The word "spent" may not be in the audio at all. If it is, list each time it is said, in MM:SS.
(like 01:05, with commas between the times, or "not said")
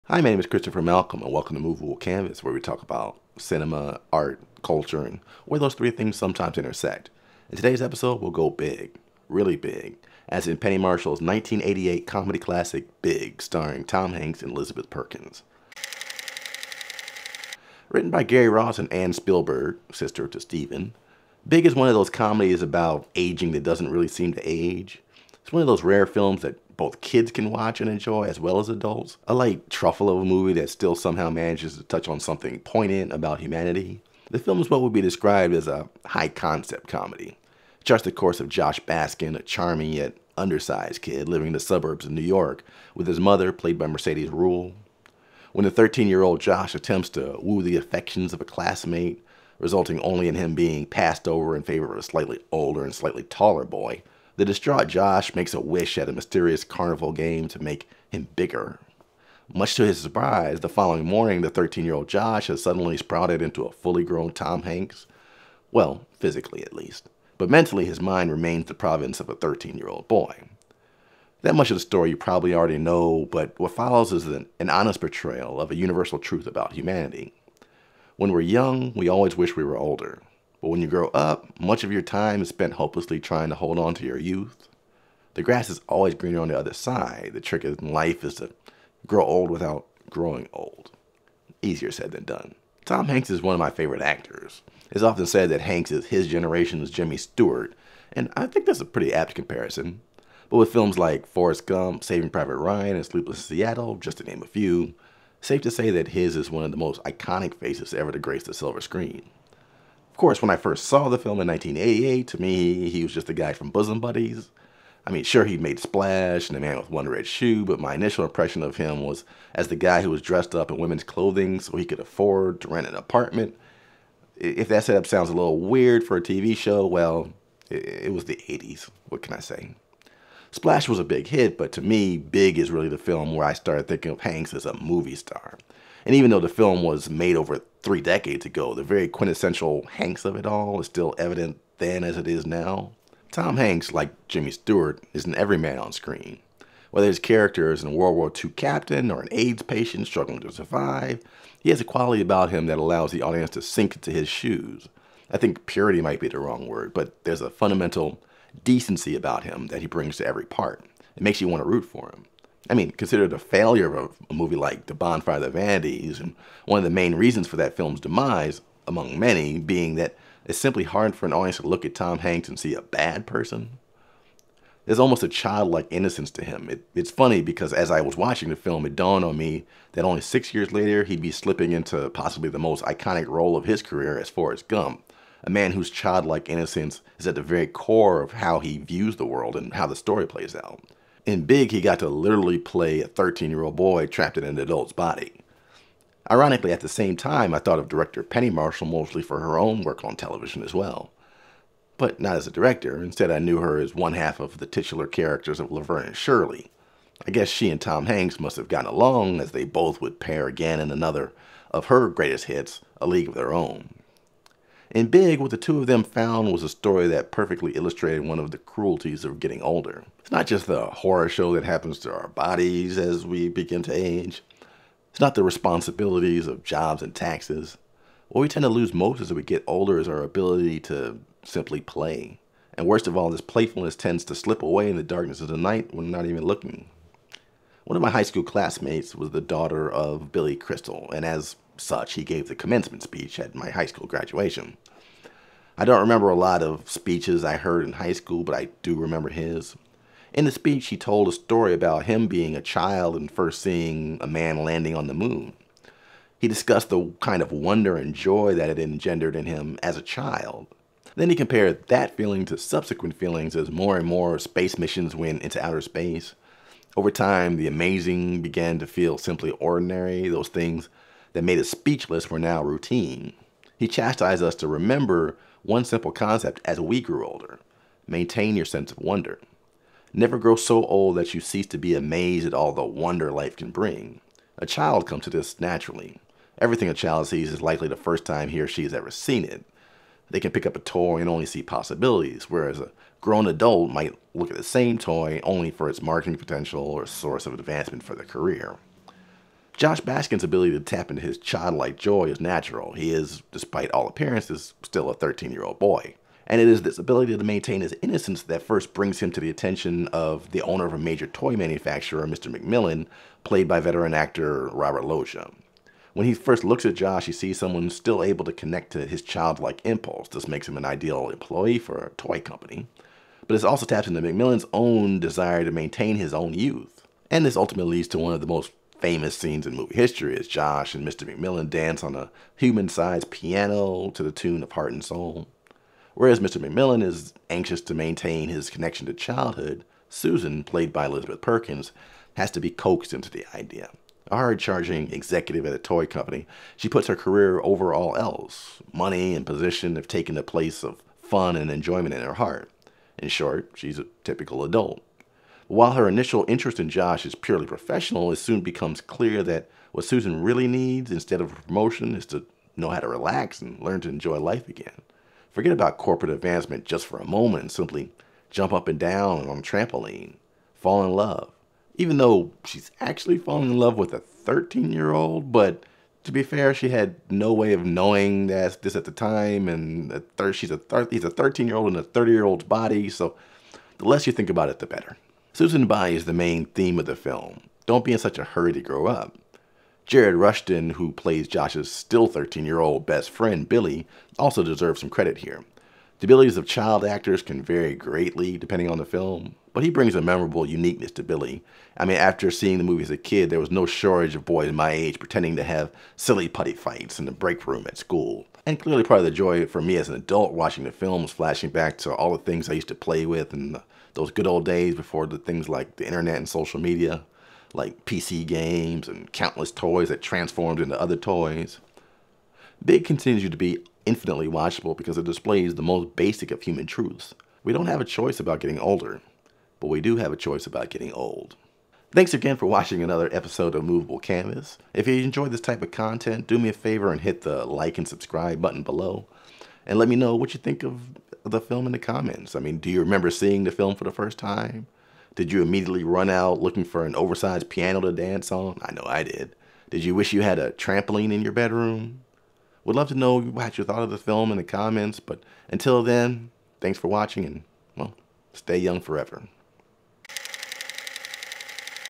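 01:22.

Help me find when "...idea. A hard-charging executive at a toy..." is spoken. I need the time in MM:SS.
05:43.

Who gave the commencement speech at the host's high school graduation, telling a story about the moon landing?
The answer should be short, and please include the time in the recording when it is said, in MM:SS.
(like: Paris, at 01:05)
Billy Crystal, at 04:00.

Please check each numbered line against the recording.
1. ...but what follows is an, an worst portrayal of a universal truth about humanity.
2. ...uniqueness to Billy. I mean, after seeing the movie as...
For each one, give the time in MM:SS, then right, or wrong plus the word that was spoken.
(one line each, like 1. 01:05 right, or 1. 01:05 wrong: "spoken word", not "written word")
1. 01:13 wrong: "honest", not "worst"
2. 06:40 right.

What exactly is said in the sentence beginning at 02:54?
There's almost a childlike innocence to him.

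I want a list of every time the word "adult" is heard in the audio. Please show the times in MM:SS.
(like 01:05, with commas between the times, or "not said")
00:28, 03:14, 04:53, 05:54, 06:50.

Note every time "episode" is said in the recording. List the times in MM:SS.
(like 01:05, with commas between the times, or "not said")
00:07, 07:13.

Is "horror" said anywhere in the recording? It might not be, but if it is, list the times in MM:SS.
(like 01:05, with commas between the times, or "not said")
03:40.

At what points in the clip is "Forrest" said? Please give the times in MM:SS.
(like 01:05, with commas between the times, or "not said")
01:41, 03:04.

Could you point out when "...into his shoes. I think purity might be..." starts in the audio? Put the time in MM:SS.
02:33.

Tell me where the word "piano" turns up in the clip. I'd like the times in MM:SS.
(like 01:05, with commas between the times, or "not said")
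05:33, 07:27.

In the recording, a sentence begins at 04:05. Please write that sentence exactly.
I don't remember a lot of speeches I heard in high school, but I do remember his.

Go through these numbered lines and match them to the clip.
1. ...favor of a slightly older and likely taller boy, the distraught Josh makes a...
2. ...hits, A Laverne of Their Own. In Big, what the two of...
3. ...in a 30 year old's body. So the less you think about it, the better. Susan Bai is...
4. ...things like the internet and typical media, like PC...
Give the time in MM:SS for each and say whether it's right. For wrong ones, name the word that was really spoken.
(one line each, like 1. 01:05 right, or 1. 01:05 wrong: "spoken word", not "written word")
1. 00:51 wrong: "slightly", not "likely"
2. 03:32 wrong: "League", not "Laverne"
3. 06:21 right
4. 06:55 wrong: "social", not "typical".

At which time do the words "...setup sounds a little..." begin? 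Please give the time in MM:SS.
02:04.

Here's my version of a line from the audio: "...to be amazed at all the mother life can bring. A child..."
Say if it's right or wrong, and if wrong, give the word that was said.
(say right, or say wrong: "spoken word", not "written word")
wrong: "wonder", not "mother".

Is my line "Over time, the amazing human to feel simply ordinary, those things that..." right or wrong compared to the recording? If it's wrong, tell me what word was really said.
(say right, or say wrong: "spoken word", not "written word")
wrong: "began", not "human".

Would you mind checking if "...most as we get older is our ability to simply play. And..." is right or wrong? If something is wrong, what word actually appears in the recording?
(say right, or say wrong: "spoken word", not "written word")
right.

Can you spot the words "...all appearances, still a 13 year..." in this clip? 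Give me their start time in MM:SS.
05:03.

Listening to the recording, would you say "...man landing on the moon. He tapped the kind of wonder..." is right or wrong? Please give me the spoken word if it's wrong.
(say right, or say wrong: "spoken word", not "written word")
wrong: "discussed", not "tapped".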